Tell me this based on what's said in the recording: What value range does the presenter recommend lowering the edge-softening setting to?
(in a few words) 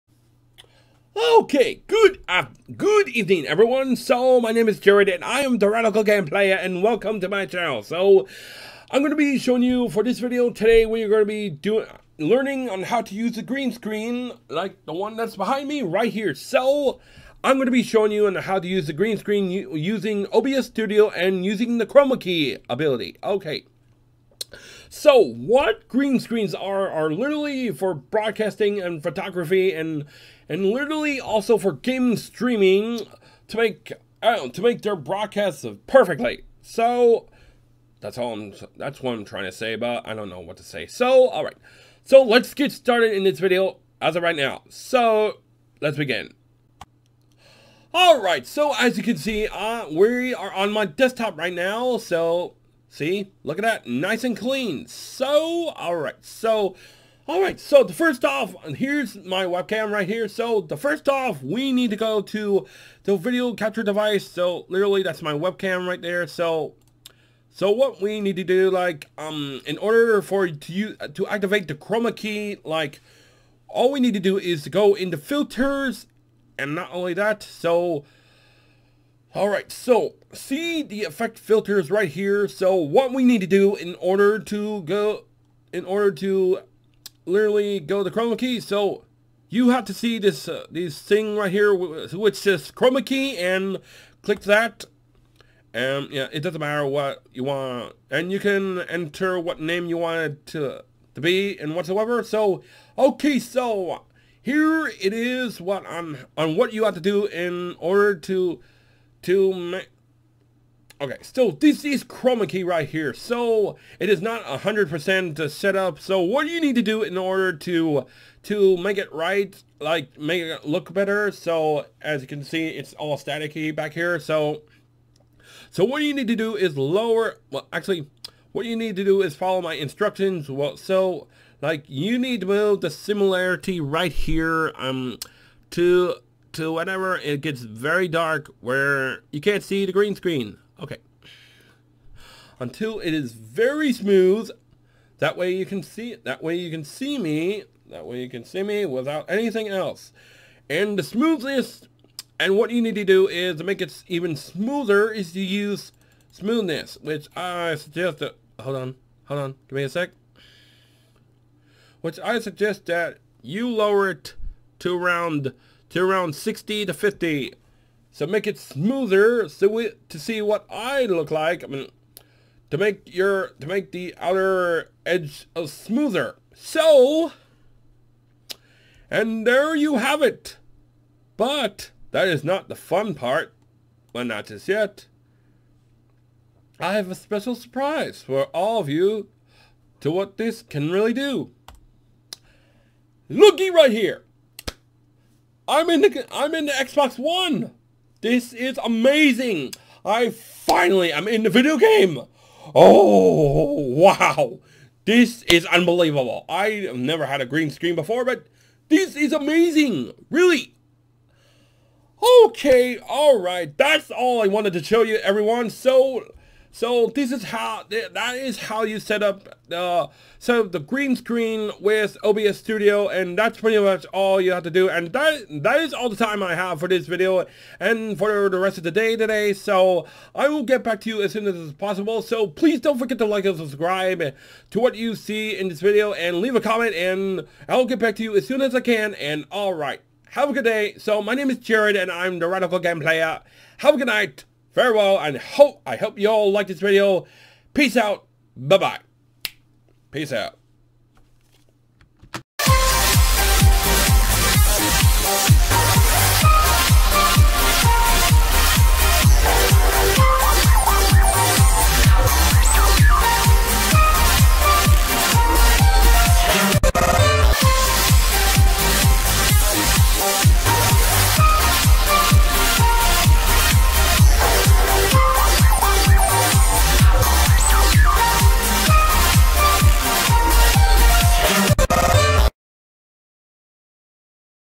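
60 to 50.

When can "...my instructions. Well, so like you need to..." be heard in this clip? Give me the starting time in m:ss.
2:09.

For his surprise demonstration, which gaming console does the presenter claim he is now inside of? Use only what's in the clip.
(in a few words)
Xbox One.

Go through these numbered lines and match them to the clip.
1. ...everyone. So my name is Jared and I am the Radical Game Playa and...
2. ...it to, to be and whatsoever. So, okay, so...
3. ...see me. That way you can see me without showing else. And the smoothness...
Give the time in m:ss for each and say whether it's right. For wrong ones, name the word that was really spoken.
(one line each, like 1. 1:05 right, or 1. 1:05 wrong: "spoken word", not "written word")
1. 0:03 right
2. 1:40 right
3. 2:26 wrong: "anything", not "showing".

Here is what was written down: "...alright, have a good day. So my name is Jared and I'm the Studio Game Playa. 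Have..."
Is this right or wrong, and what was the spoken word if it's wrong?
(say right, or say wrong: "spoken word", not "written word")
wrong: "Radical", not "Studio".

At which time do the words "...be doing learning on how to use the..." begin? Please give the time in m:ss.
0:11.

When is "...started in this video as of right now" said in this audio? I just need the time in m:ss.
0:42.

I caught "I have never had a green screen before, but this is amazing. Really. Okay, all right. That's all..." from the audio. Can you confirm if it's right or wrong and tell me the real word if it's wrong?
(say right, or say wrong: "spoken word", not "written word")
right.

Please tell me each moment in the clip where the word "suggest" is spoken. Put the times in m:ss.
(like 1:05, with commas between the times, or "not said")
2:37, 2:42.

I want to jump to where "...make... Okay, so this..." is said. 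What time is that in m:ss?
1:49.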